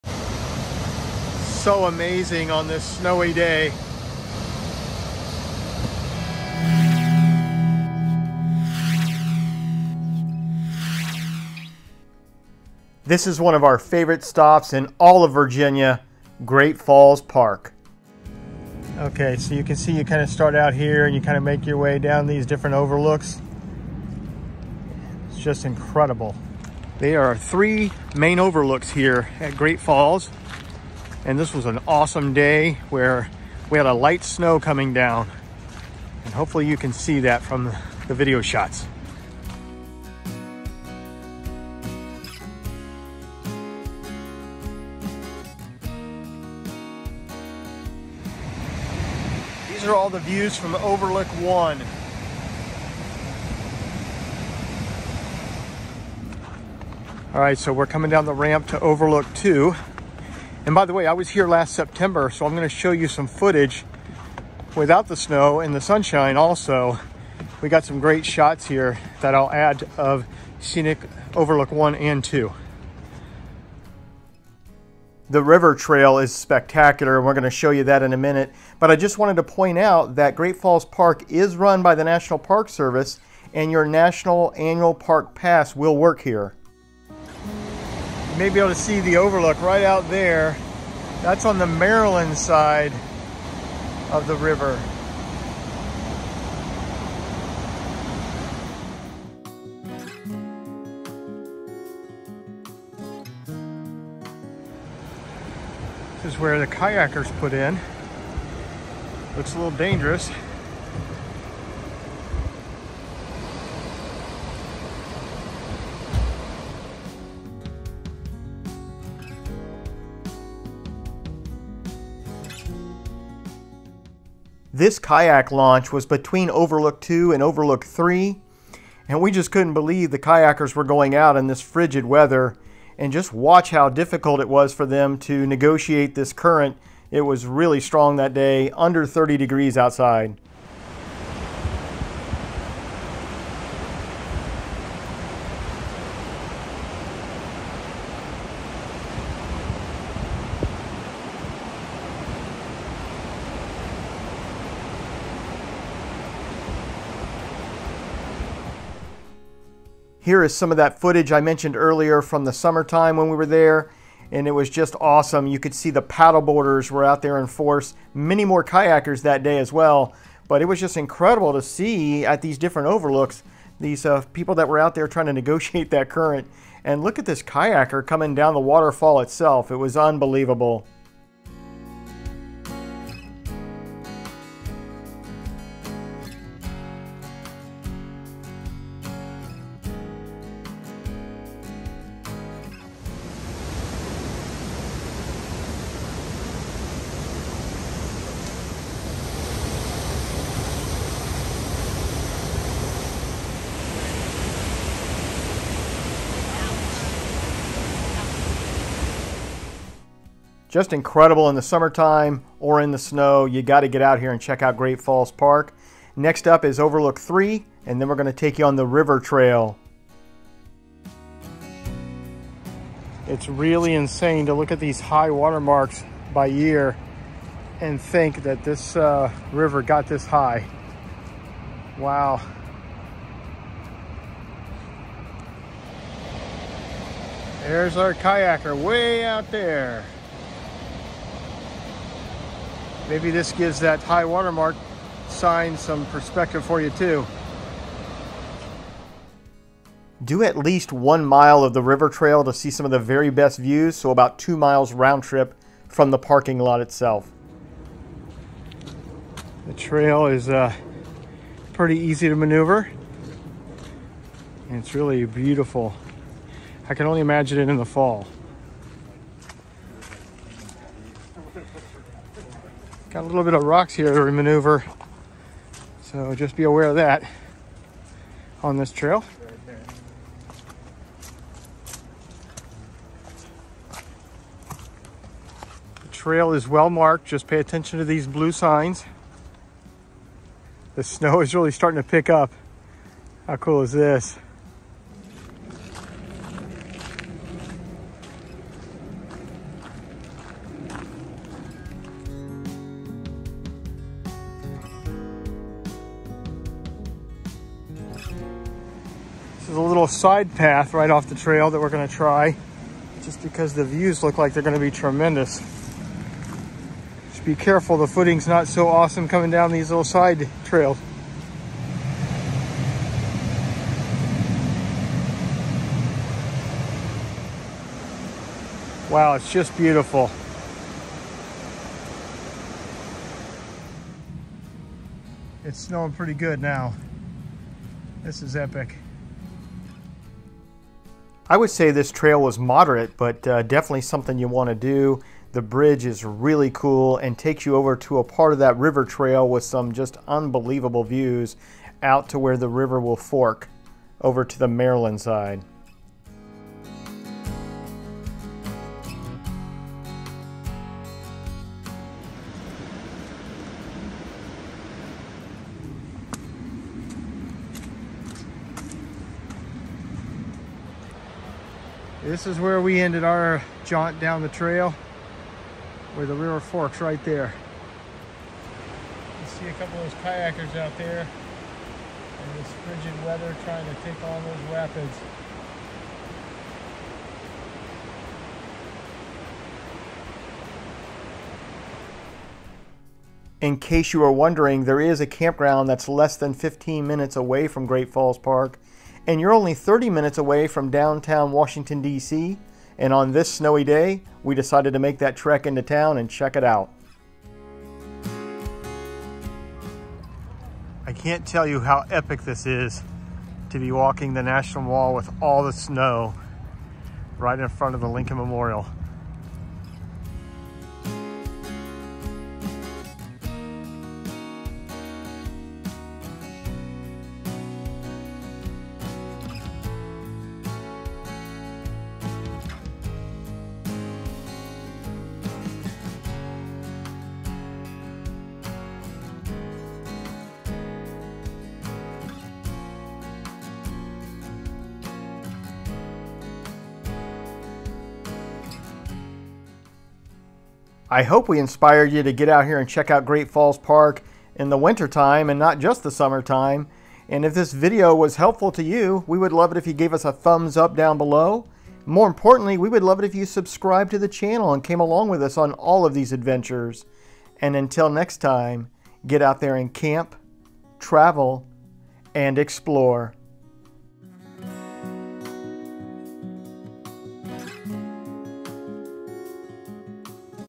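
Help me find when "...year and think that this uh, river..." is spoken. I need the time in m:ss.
3:46.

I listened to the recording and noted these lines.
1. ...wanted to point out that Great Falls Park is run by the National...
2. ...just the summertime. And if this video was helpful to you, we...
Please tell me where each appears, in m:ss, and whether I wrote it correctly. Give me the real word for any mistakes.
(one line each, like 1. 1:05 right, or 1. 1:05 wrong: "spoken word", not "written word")
1. 1:19 right
2. 7:35 right.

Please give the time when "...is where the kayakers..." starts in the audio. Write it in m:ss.
1:46.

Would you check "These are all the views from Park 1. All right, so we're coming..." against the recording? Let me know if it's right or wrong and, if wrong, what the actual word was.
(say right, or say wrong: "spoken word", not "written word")
wrong: "Overlook", not "Park".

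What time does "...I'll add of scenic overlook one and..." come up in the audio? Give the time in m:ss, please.
1:09.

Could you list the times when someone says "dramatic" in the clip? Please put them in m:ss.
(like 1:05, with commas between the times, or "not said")
not said.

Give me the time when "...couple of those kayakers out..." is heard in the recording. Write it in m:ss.
6:19.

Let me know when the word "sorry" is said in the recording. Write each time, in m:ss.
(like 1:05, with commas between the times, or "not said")
not said.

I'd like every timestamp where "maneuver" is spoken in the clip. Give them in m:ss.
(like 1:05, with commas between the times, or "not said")
4:22, 4:34.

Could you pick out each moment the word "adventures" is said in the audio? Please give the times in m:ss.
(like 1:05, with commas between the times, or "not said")
7:46.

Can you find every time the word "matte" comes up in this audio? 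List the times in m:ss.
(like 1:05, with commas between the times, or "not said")
not said.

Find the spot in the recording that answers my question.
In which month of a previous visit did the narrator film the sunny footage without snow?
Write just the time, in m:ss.
1:01.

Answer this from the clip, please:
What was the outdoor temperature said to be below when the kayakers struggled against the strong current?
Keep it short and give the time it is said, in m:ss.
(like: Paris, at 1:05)
30 degrees, at 2:19.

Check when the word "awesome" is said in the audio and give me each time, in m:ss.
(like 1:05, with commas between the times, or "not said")
0:31, 2:45, 5:18.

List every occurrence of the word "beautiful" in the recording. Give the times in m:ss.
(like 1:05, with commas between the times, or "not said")
4:25, 5:29.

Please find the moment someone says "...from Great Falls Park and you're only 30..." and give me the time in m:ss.
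6:37.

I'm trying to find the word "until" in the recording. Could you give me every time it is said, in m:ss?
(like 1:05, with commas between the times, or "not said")
7:47.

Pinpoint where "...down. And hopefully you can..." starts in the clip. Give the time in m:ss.
0:34.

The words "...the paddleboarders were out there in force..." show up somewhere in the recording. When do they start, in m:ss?
2:45.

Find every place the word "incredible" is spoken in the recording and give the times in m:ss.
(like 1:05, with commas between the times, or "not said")
0:25, 2:50, 3:30.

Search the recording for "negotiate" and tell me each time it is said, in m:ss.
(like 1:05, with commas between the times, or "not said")
2:15, 2:55.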